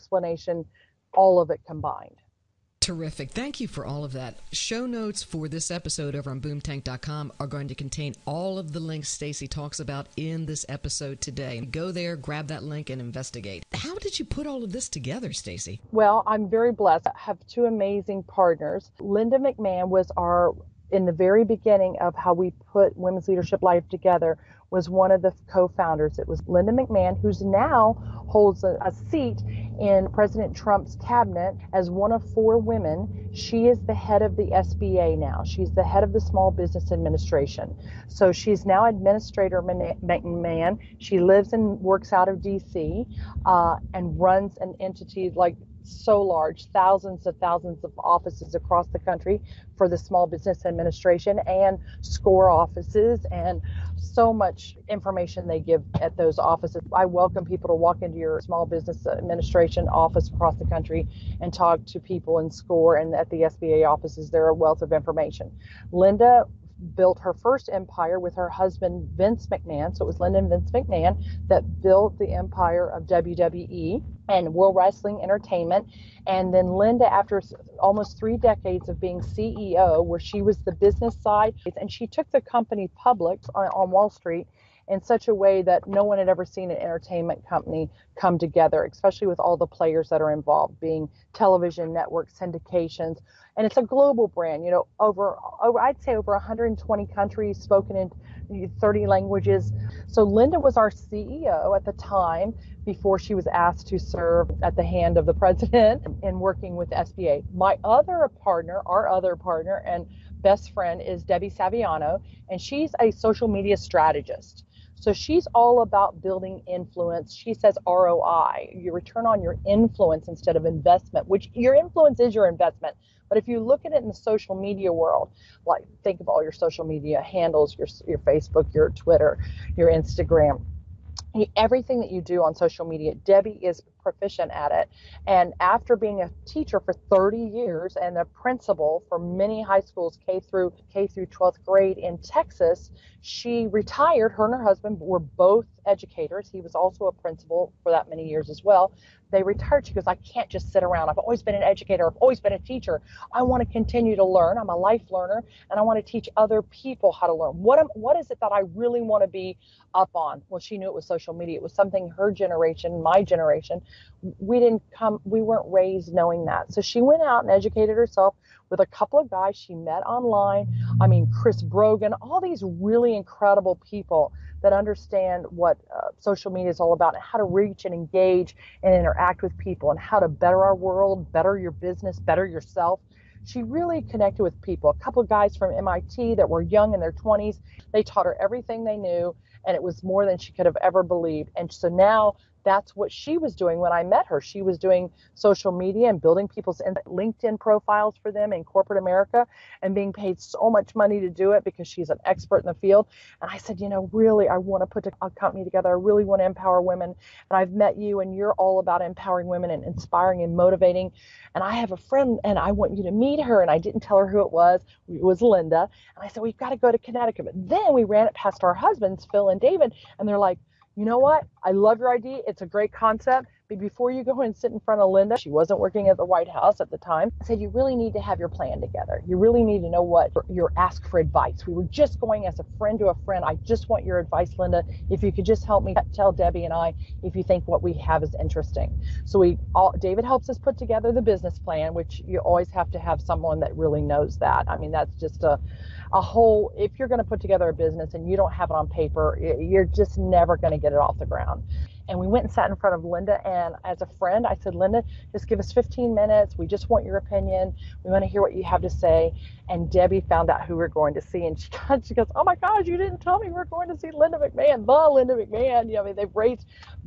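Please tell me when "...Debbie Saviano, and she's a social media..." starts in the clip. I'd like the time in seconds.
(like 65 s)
111 s.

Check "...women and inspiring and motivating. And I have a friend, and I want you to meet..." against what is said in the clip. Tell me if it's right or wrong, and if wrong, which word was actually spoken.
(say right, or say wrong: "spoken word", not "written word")
right.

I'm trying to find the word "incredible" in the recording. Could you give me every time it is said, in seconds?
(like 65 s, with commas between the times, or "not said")
173 s.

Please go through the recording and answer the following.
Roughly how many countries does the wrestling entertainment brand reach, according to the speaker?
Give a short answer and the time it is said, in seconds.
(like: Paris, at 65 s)
120, at 96 s.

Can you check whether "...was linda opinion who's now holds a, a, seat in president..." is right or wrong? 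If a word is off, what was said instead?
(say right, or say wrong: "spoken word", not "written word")
wrong: "mcmahon", not "opinion".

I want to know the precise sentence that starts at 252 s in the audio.
And we went and sat in front of Linda.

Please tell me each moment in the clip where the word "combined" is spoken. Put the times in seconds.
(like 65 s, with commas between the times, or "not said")
1 s.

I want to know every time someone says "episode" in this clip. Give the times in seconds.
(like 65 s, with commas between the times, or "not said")
5 s, 10 s.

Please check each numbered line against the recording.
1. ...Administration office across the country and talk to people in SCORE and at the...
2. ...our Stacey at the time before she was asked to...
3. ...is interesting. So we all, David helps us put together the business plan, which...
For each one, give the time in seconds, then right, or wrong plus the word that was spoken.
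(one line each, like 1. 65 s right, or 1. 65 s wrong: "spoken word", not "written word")
1. 59 s right
2. 100 s wrong: "CEO", not "Stacey"
3. 238 s right.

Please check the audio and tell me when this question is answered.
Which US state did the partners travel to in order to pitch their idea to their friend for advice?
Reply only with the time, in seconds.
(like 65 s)
216 s.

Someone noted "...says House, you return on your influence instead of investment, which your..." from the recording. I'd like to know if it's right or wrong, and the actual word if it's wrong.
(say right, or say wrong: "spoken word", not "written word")
wrong: "ROI", not "House".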